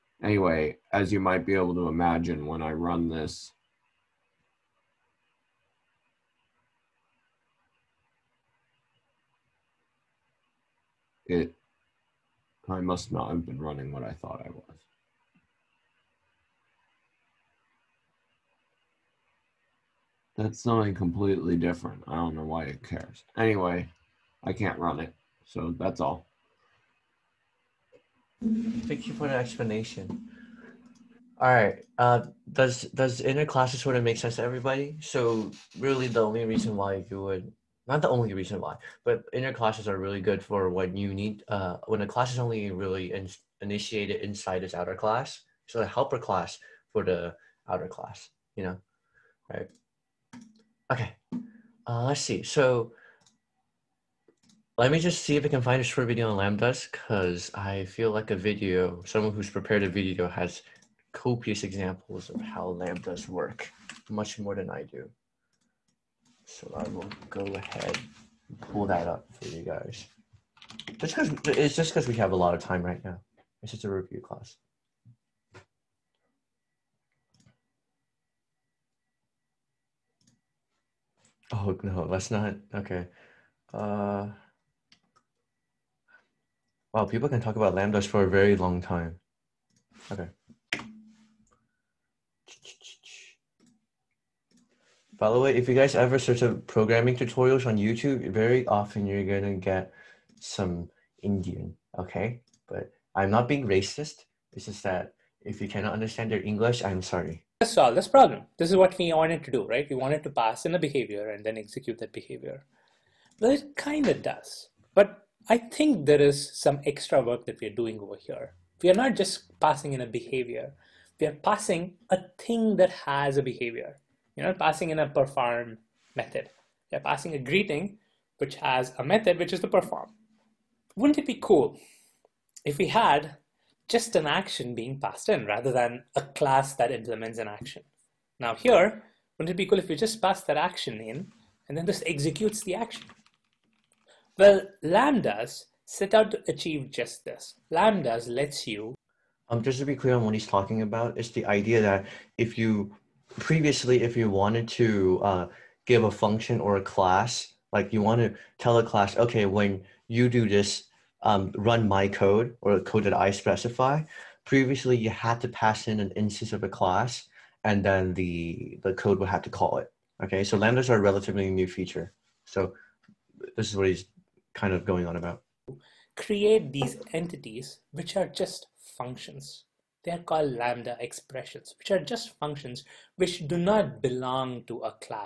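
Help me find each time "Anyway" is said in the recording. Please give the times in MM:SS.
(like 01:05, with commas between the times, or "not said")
00:00, 00:23.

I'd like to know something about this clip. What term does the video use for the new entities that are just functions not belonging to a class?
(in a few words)
lambda expressions.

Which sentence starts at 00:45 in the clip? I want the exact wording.
So the helper class for the outer class, you know, right?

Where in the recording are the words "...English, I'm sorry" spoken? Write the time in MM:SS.
01:46.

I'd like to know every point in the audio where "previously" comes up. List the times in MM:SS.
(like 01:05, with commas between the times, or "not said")
02:33, 02:44.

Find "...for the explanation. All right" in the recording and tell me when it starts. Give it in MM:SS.
00:29.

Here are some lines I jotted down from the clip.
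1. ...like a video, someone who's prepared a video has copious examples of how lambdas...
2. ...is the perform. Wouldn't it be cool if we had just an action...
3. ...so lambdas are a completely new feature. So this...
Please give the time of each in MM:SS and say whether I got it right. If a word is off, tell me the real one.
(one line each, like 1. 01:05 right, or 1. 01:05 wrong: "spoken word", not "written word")
1. 00:58 right
2. 02:09 right
3. 02:50 wrong: "relatively", not "completely".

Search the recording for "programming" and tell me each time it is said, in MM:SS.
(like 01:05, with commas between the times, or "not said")
01:36.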